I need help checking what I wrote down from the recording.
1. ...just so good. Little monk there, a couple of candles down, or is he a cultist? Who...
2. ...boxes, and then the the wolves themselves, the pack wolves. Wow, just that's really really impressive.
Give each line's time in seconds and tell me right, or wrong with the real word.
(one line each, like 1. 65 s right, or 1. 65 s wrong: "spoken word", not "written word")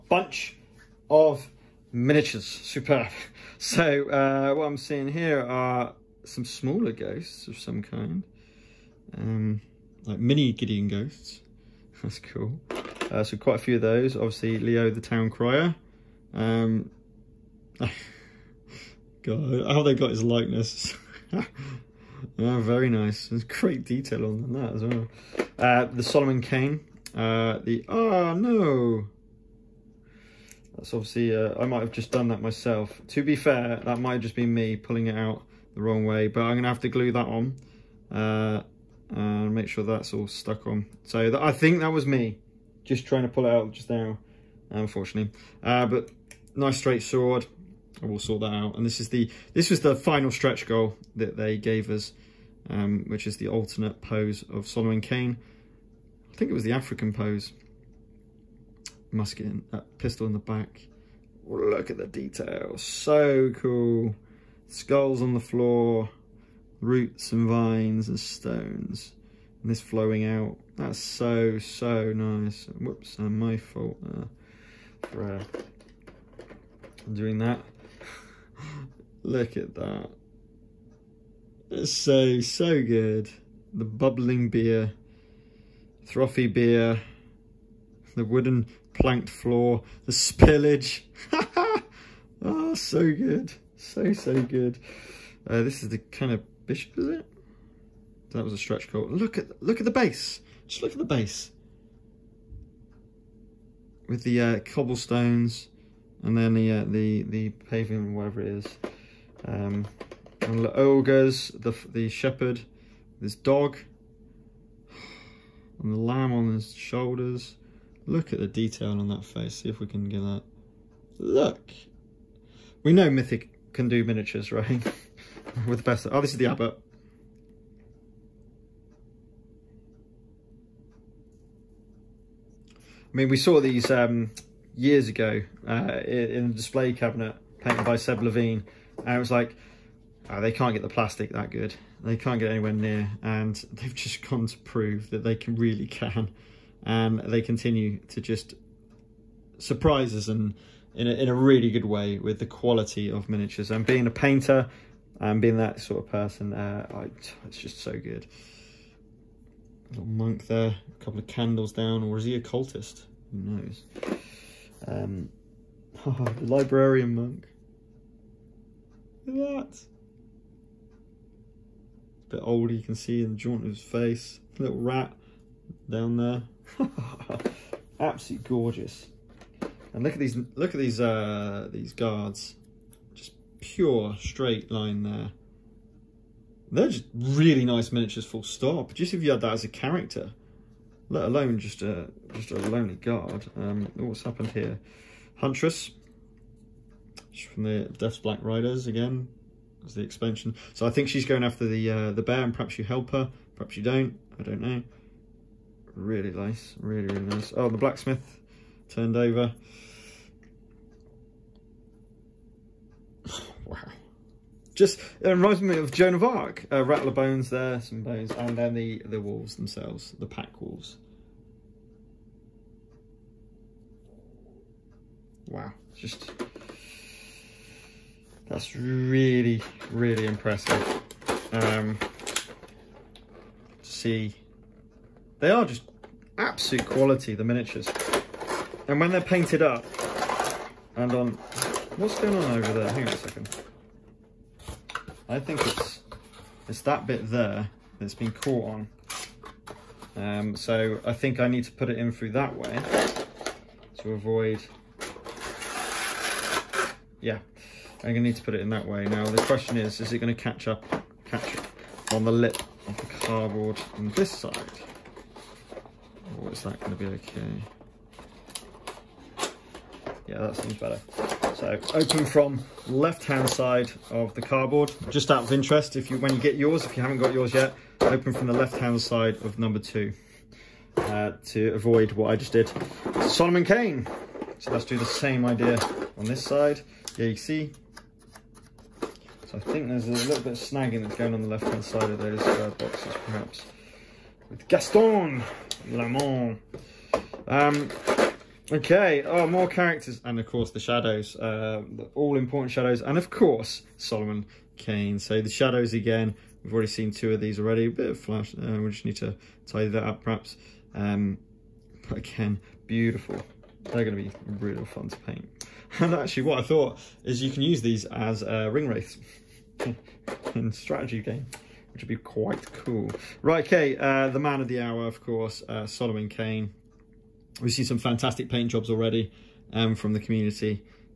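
1. 157 s right
2. 218 s wrong: "bones", not "boxes".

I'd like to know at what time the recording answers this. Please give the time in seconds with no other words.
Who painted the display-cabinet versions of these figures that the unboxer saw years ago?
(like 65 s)
137 s.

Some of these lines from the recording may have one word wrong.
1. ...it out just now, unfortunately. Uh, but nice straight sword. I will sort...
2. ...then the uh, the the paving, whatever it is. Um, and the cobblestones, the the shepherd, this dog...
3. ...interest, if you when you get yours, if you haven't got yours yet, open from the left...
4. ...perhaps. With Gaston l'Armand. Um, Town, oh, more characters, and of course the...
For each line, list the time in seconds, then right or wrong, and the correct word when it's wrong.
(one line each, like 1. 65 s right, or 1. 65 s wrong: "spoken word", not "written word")
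1. 43 s right
2. 106 s wrong: "ogres", not "cobblestones"
3. 275 s right
4. 293 s wrong: "Okay", not "Town".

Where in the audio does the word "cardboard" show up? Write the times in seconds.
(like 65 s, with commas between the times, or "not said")
263 s, 274 s.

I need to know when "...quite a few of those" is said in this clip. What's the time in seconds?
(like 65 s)
13 s.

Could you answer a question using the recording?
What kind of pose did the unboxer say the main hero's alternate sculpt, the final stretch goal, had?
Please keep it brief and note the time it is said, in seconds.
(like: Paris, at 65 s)
African pose, at 56 s.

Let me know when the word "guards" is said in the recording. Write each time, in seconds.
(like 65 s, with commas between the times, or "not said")
181 s, 192 s.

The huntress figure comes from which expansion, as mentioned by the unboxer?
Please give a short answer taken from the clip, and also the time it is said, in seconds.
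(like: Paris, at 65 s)
Death's Black Riders, at 197 s.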